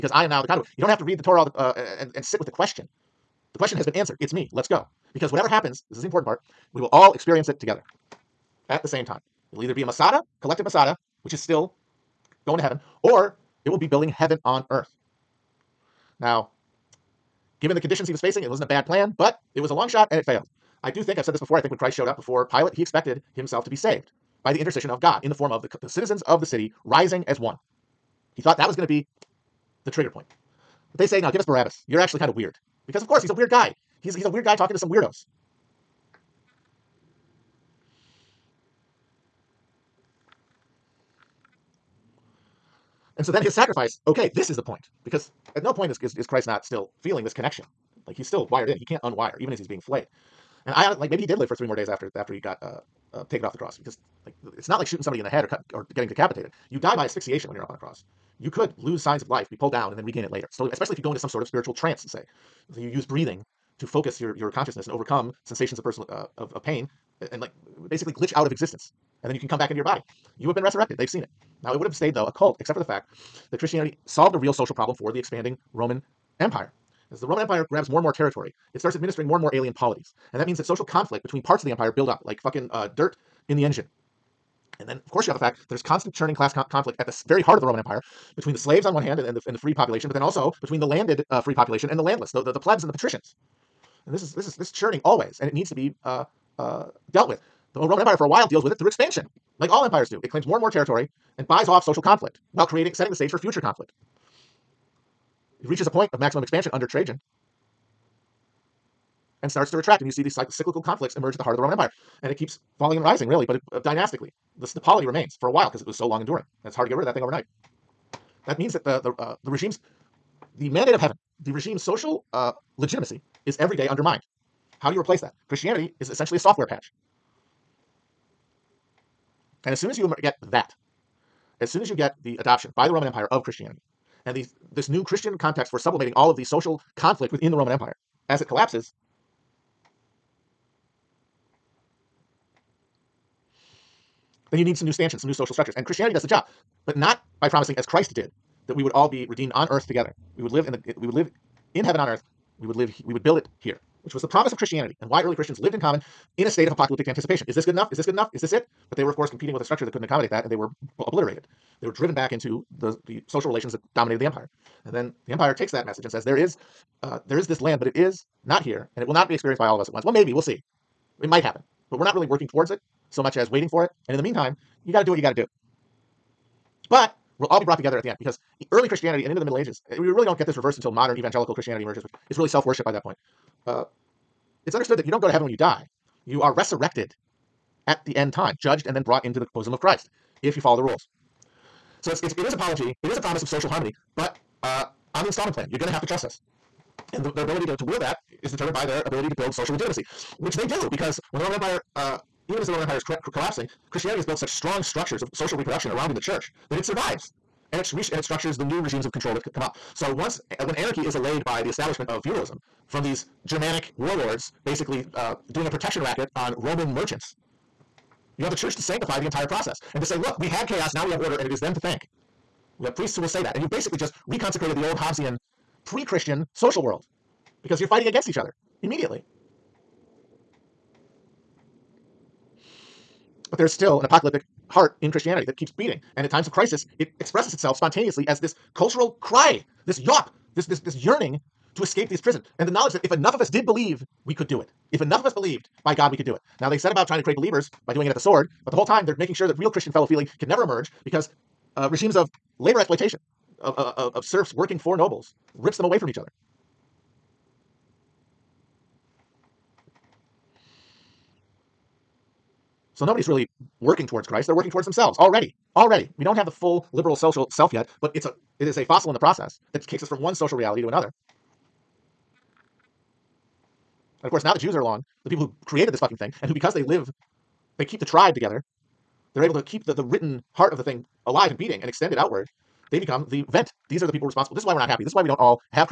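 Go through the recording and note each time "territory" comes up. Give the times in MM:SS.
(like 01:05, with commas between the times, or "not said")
01:18, 01:40.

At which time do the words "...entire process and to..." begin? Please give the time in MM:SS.
03:39.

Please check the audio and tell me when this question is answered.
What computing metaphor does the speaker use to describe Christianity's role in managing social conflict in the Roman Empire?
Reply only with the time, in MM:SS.
02:06.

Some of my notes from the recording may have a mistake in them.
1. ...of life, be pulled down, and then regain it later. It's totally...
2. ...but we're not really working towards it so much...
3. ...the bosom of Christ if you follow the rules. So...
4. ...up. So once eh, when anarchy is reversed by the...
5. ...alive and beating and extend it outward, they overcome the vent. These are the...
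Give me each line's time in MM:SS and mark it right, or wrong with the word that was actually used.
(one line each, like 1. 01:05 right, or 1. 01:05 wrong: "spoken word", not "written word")
1. 00:59 right
2. 02:51 right
3. 03:09 right
4. 03:29 wrong: "allayed", not "reversed"
5. 04:41 wrong: "become", not "overcome".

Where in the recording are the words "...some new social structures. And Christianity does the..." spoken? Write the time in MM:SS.
02:25.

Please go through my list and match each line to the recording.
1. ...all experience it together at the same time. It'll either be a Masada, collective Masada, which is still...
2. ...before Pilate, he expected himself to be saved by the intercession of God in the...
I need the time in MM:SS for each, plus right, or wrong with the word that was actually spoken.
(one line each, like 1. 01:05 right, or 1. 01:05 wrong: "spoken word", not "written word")
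1. 00:06 right
2. 00:22 right.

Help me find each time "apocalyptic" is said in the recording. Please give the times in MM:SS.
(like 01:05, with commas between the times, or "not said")
02:36, 03:54.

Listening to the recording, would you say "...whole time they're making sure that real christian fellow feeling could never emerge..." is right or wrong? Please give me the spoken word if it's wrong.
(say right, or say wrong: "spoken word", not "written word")
right.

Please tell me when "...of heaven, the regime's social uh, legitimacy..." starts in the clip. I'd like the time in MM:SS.
02:00.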